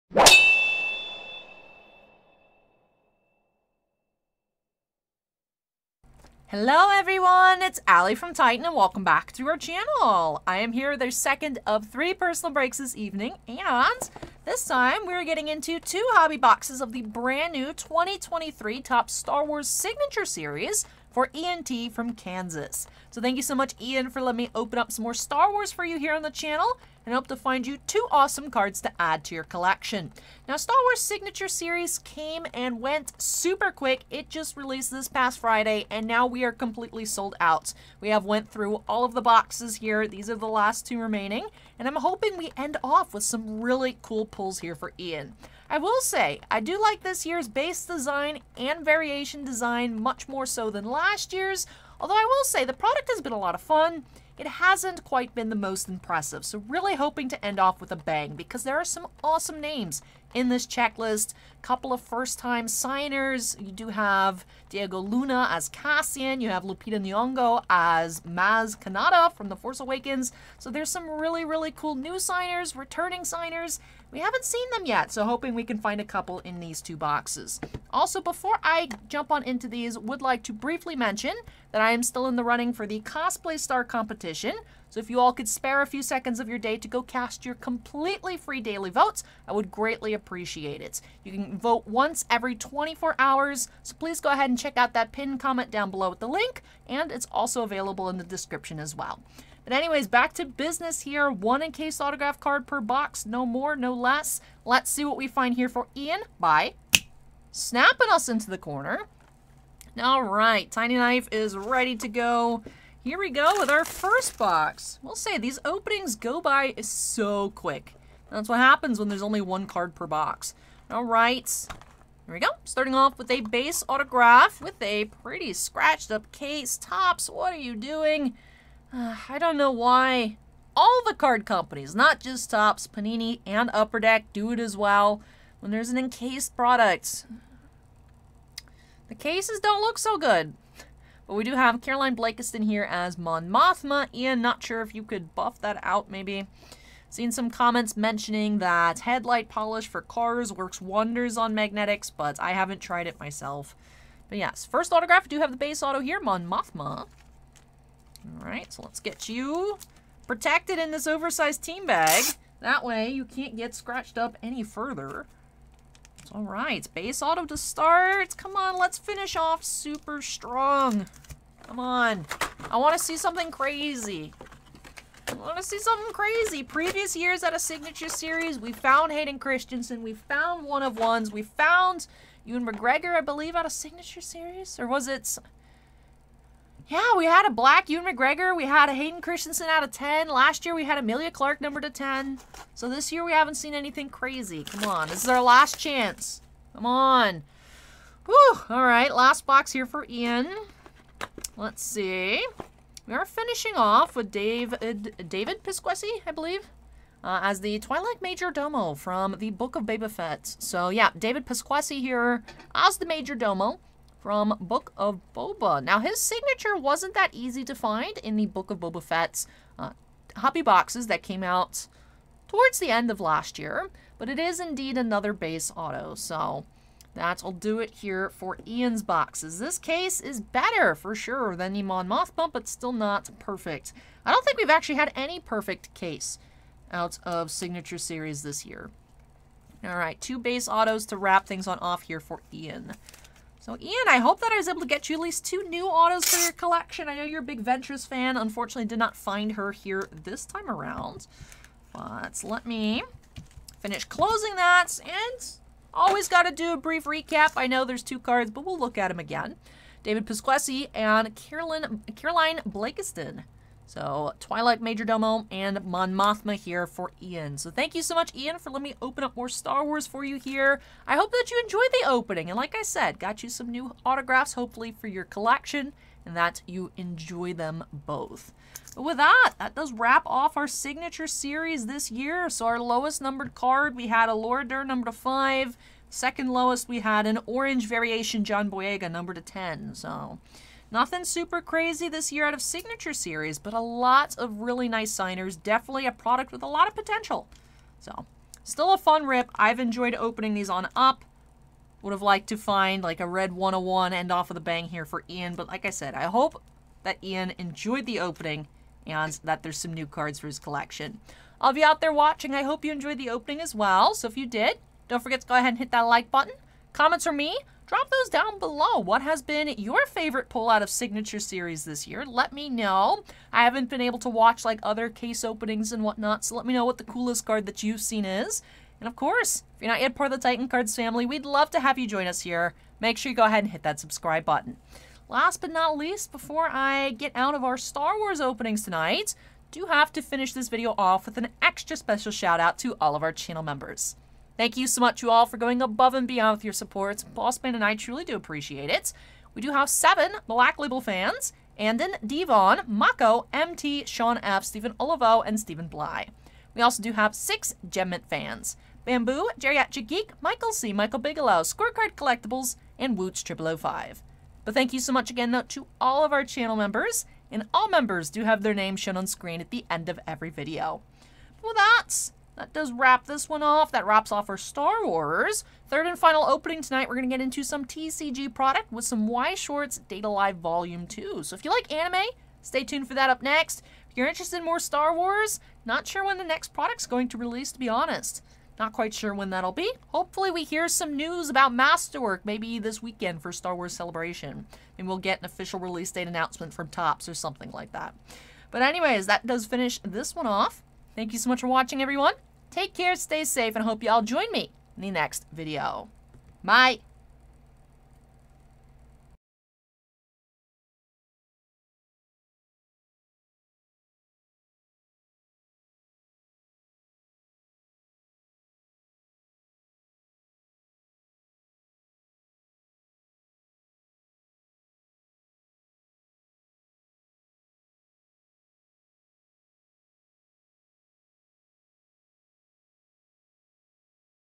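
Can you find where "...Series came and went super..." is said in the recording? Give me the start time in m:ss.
0:31.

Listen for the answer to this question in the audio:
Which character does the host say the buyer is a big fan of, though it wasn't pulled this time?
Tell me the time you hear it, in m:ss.
4:07.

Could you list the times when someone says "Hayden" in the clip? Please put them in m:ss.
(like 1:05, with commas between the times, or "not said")
2:59, 3:08.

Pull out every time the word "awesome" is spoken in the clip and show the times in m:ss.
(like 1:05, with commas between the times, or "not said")
0:28, 0:59.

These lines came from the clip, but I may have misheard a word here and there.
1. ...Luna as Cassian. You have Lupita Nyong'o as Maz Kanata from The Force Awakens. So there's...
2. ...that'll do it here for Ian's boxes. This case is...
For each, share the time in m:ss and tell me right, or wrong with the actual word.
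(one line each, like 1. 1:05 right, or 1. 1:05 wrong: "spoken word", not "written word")
1. 1:04 right
2. 3:47 right.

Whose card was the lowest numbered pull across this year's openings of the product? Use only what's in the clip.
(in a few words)
Laura Dern.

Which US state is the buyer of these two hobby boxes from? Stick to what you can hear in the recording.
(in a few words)
Kansas.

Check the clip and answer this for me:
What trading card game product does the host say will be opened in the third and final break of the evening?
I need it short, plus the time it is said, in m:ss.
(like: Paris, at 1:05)
Weiss Schwarz, at 6:19.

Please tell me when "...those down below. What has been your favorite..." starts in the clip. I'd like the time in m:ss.
5:18.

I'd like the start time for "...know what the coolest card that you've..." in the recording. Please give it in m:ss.
5:26.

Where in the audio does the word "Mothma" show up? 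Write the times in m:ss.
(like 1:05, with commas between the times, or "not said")
2:23, 2:36, 3:52, 4:26.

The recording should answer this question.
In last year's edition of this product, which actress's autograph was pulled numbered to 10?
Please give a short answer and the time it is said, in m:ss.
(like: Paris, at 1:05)
Emilia Clarke, at 3:10.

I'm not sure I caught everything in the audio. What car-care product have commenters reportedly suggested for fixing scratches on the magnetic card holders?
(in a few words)
Headlight polish.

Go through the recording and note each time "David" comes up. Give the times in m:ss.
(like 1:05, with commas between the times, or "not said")
3:25, 3:31, 4:20.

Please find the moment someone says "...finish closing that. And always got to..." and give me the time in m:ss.
4:13.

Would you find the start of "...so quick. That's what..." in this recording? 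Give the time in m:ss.
1:56.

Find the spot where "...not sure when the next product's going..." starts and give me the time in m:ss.
6:25.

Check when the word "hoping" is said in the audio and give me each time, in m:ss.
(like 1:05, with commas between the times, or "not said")
0:41, 0:56, 1:15.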